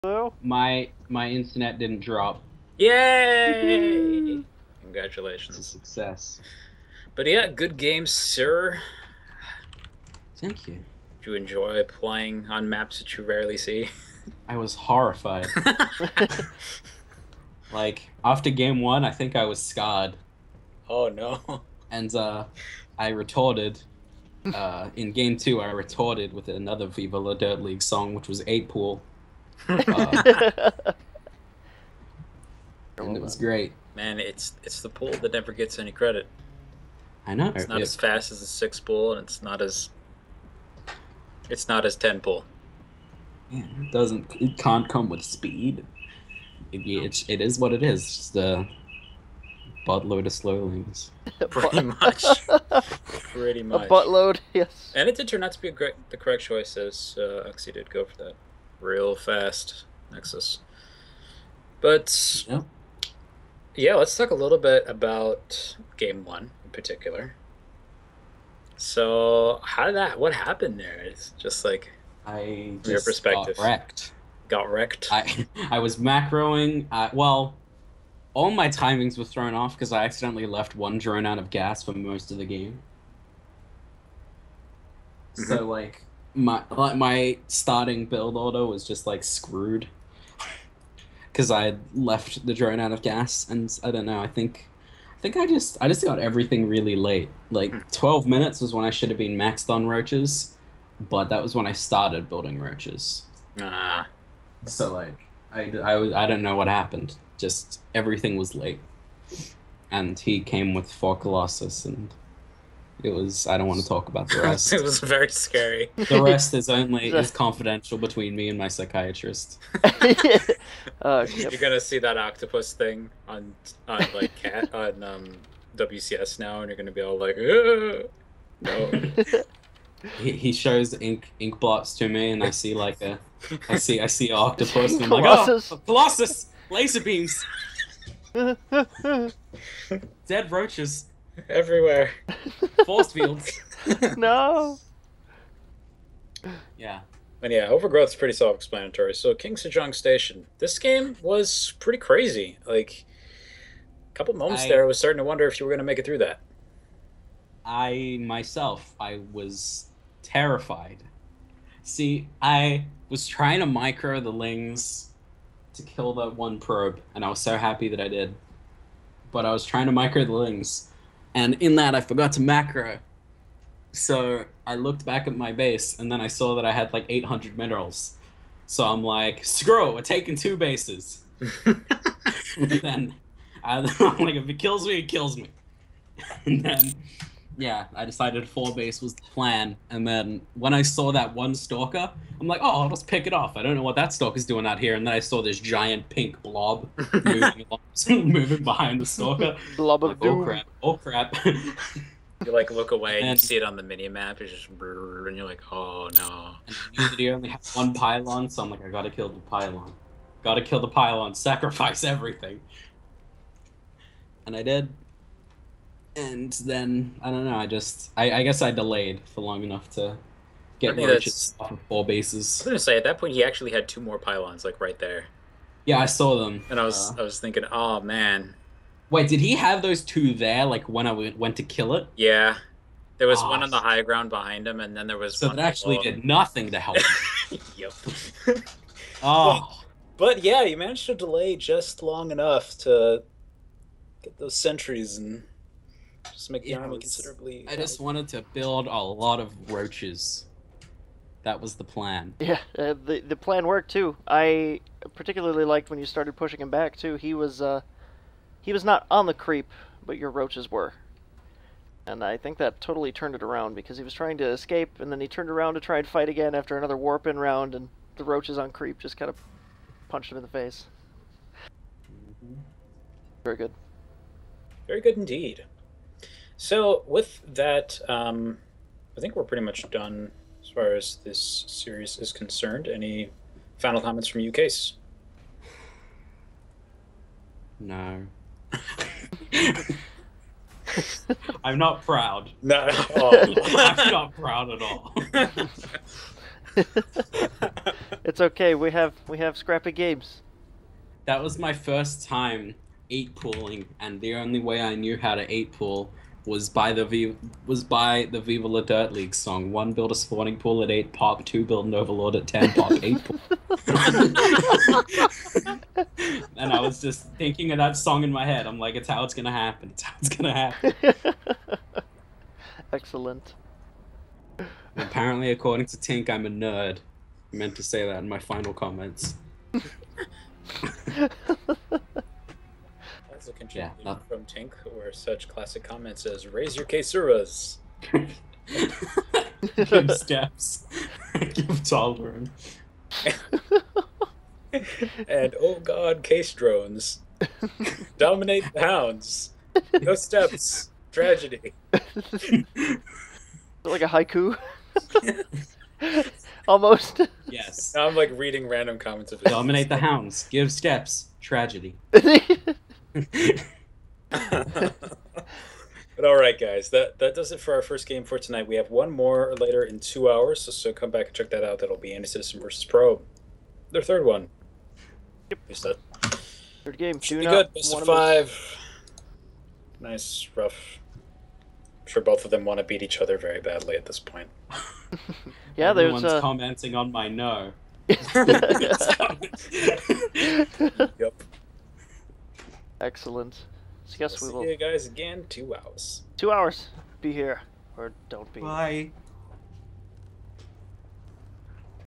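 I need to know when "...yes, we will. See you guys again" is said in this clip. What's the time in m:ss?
6:34.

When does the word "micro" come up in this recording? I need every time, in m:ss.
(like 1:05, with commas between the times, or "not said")
2:43, 2:49.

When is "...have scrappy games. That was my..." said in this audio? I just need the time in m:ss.
4:59.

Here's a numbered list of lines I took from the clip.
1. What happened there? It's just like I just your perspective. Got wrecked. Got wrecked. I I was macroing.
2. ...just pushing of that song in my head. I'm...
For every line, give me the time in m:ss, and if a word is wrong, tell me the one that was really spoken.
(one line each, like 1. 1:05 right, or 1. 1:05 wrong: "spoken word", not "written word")
1. 1:10 right
2. 5:17 wrong: "thinking", not "pushing".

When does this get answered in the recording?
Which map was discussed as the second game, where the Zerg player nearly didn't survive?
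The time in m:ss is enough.
2:29.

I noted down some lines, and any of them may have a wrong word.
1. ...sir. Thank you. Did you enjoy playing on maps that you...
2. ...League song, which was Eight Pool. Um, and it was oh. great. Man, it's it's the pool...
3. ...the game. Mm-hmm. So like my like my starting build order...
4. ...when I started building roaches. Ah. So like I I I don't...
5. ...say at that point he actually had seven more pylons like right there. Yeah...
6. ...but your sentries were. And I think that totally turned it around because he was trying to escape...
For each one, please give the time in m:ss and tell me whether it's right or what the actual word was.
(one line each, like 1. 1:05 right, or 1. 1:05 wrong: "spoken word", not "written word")
1. 0:08 right
2. 0:27 right
3. 1:22 right
4. 1:41 right
5. 3:42 wrong: "two", not "seven"
6. 4:20 wrong: "roaches", not "sentries".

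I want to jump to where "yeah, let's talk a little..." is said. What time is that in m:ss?
1:03.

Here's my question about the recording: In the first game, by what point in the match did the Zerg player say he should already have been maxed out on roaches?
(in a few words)
12 minutes.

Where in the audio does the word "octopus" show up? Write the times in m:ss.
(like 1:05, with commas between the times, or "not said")
2:02, 2:14.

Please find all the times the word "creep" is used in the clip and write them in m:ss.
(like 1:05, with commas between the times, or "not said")
4:19, 4:28.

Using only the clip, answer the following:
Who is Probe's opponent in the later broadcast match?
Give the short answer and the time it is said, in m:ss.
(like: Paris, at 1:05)
Anti Citizen, at 6:12.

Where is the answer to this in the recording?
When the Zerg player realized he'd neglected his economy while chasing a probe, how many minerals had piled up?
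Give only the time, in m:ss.
2:57.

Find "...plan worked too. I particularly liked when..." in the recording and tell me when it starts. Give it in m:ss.
4:13.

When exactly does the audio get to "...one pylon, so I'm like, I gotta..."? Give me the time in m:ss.
3:27.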